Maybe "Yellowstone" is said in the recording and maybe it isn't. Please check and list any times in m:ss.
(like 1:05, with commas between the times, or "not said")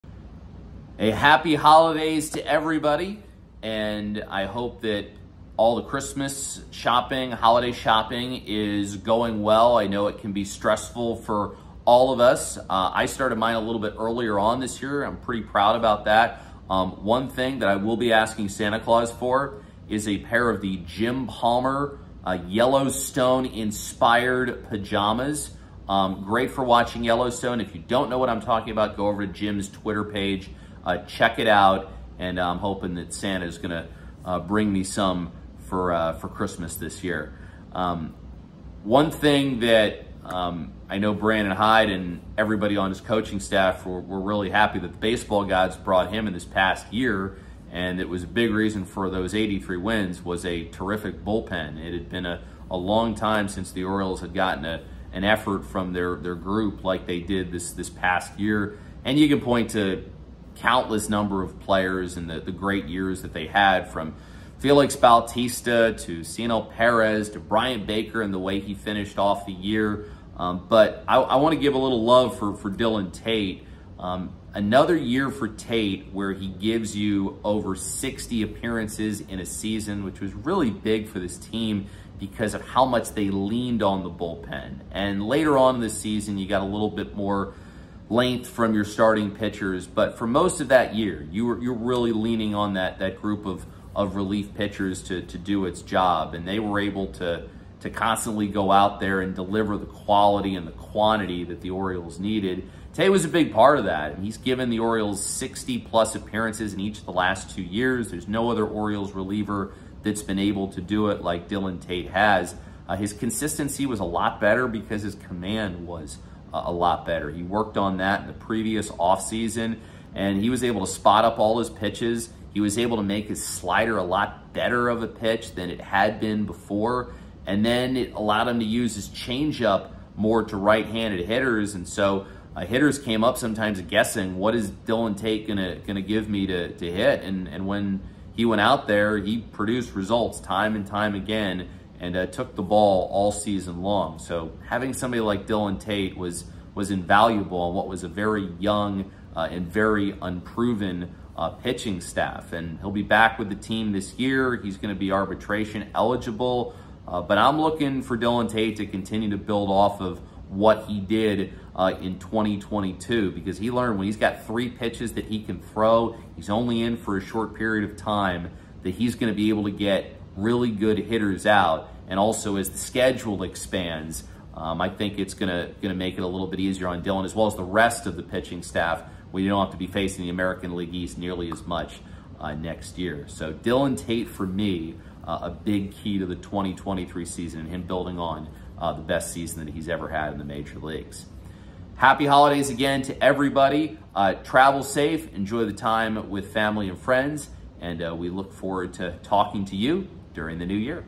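0:22, 0:27.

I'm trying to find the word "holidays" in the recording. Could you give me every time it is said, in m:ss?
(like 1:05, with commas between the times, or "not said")
0:01, 0:07, 3:12.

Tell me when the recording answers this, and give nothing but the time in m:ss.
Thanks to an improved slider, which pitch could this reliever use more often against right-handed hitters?
2:09.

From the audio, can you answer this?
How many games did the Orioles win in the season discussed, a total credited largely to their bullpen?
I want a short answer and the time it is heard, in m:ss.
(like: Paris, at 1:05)
83, at 0:49.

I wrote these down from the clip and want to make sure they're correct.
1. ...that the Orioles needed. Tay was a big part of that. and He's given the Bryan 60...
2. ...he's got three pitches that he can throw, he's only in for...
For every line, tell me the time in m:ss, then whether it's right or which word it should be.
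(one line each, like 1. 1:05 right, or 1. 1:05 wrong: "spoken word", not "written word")
1. 1:41 wrong: "Orioles", not "Bryan"
2. 2:44 right.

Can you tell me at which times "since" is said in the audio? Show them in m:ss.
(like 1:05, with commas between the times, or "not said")
0:53.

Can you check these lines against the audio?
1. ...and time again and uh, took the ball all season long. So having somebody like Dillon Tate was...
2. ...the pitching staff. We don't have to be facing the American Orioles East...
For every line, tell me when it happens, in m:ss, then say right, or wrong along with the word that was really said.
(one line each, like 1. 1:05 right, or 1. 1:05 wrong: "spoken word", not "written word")
1. 2:20 right
2. 2:58 wrong: "League", not "Orioles".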